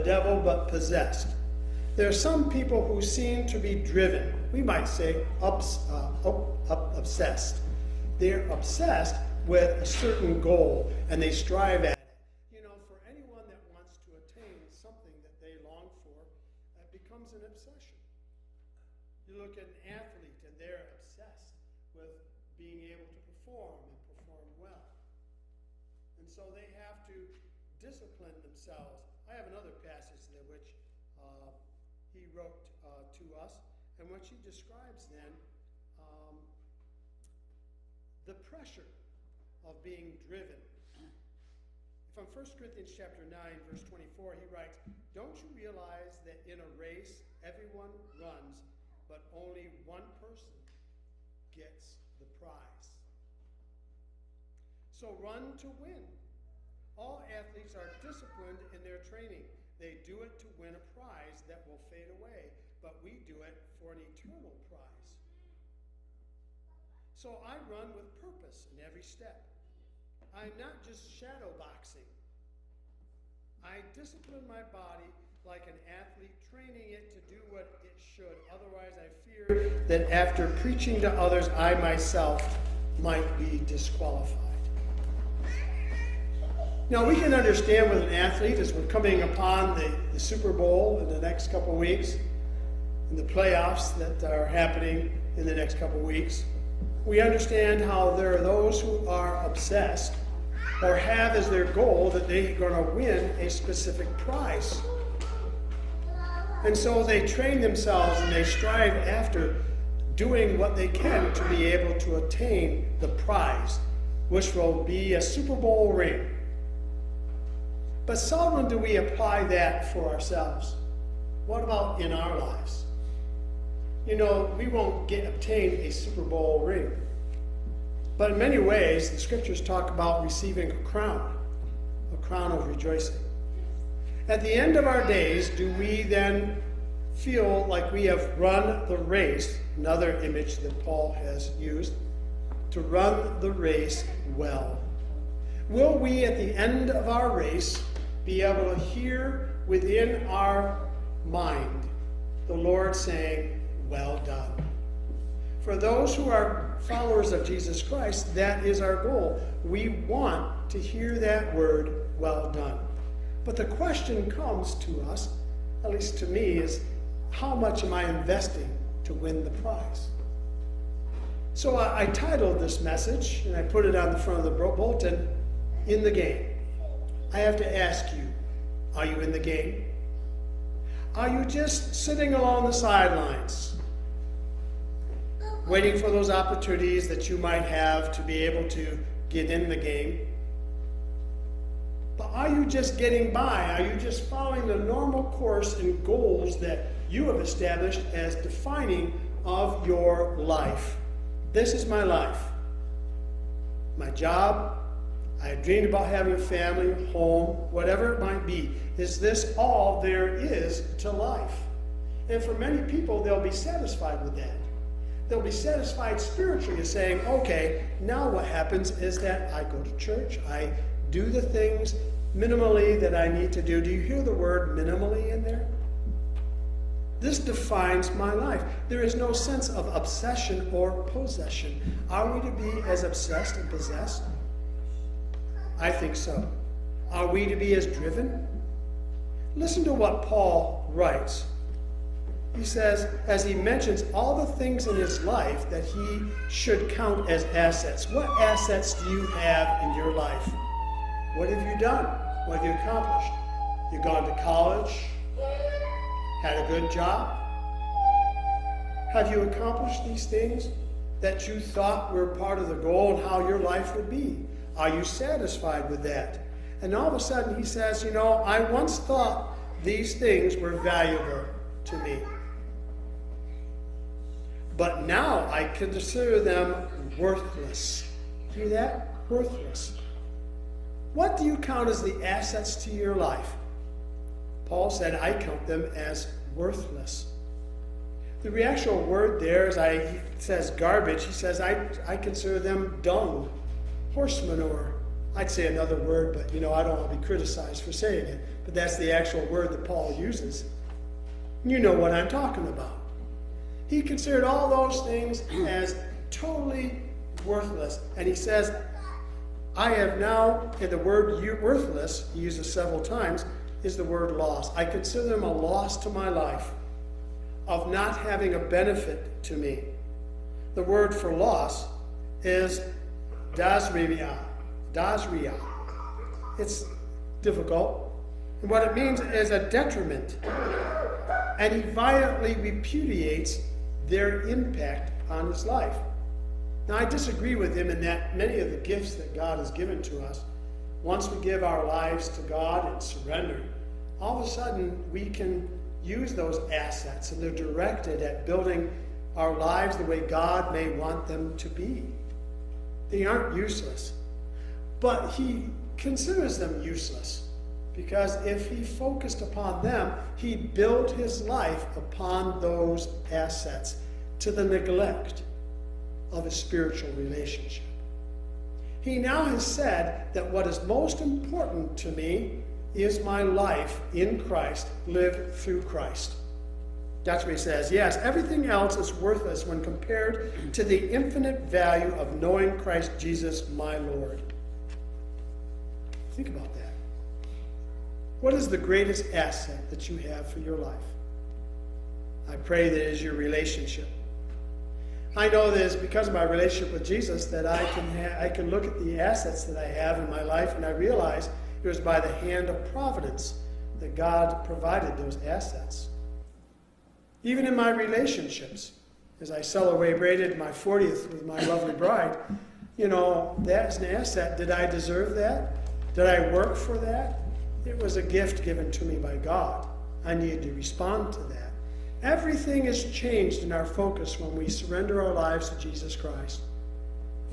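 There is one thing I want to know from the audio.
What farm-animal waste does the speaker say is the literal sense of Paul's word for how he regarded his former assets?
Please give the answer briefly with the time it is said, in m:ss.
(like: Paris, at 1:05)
Horse manure, at 4:54.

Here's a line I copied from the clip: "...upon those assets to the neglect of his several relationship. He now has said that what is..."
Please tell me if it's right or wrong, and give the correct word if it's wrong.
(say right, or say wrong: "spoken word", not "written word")
wrong: "spiritual", not "several".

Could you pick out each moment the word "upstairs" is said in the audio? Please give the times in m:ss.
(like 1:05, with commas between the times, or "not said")
not said.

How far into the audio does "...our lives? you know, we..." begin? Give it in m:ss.
2:02.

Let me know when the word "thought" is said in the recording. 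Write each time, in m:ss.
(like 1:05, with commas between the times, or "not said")
4:21, 4:28.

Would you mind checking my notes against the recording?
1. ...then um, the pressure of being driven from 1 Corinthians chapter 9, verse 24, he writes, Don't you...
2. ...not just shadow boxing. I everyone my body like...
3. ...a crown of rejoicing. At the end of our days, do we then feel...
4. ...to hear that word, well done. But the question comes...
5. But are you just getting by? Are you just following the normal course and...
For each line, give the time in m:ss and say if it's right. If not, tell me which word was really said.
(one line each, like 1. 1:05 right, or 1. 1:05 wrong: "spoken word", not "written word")
1. 0:35 right
2. 1:10 wrong: "discipline", not "everyone"
3. 2:12 right
4. 2:40 right
5. 3:12 right.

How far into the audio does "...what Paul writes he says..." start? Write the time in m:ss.
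3:59.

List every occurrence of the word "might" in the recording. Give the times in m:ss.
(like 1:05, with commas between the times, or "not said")
0:04, 1:22, 3:07, 3:28.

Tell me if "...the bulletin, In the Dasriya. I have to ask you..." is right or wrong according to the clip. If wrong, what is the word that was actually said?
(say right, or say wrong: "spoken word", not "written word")
wrong: "Game", not "Dasriya".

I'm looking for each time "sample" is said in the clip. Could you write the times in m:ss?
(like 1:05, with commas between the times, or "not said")
not said.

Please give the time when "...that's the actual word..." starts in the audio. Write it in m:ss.
4:58.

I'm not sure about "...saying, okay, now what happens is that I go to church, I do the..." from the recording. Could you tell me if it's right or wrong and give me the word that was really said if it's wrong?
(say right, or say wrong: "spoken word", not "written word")
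right.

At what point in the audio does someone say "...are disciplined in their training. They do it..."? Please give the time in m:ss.
0:57.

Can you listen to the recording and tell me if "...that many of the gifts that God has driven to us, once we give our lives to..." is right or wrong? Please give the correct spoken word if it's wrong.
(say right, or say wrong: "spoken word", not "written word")
wrong: "given", not "driven".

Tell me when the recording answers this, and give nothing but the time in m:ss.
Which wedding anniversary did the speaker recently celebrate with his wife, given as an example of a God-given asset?
6:50.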